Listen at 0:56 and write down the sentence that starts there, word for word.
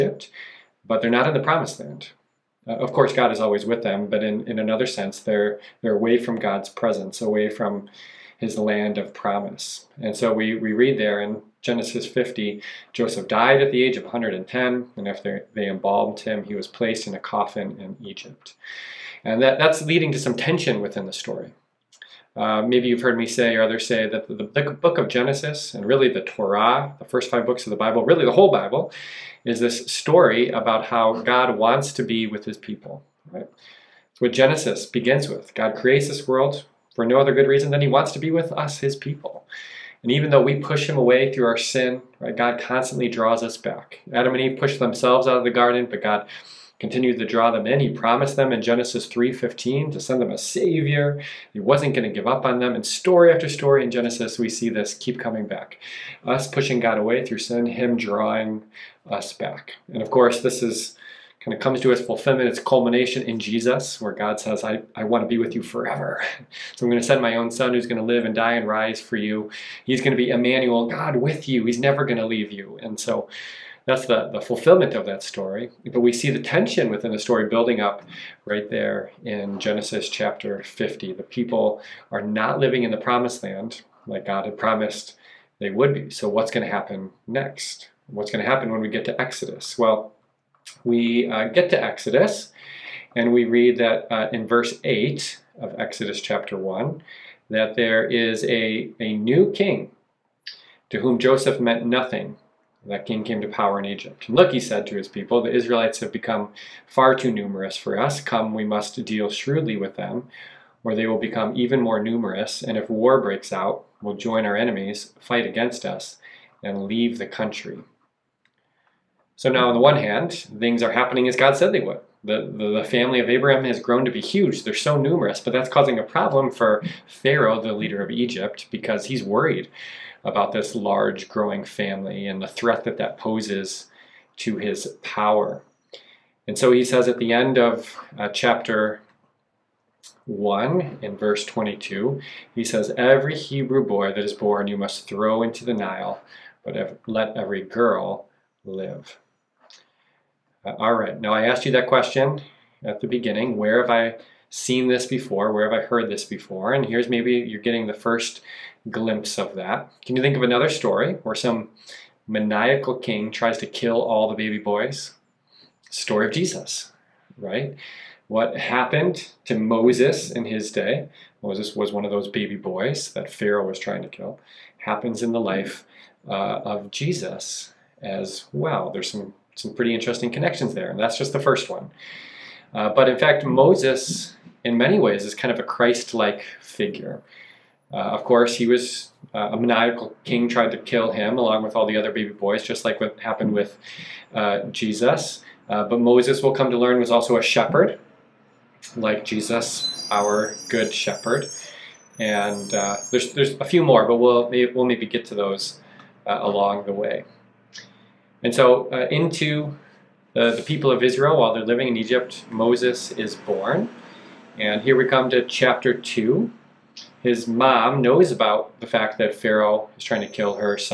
Us pushing God away through sin, him drawing us back.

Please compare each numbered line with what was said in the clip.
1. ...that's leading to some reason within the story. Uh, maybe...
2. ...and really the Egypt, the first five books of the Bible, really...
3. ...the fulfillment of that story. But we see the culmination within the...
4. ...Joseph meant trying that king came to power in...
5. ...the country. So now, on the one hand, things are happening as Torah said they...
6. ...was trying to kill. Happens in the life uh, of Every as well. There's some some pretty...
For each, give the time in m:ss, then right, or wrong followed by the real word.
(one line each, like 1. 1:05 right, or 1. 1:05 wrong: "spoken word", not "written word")
1. 0:19 wrong: "tension", not "reason"
2. 0:25 wrong: "Torah", not "Egypt"
3. 1:14 wrong: "tension", not "culmination"
4. 1:41 wrong: "nothing", not "trying"
5. 1:57 wrong: "God", not "Torah"
6. 2:53 wrong: "Jesus", not "Every".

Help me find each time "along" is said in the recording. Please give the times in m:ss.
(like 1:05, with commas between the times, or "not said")
3:11, 3:26.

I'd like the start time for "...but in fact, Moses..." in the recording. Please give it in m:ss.
3:02.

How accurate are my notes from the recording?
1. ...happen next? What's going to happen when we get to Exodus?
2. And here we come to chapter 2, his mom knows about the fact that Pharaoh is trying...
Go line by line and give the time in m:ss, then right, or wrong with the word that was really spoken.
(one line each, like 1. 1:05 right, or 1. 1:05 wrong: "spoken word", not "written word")
1. 1:26 right
2. 3:34 right.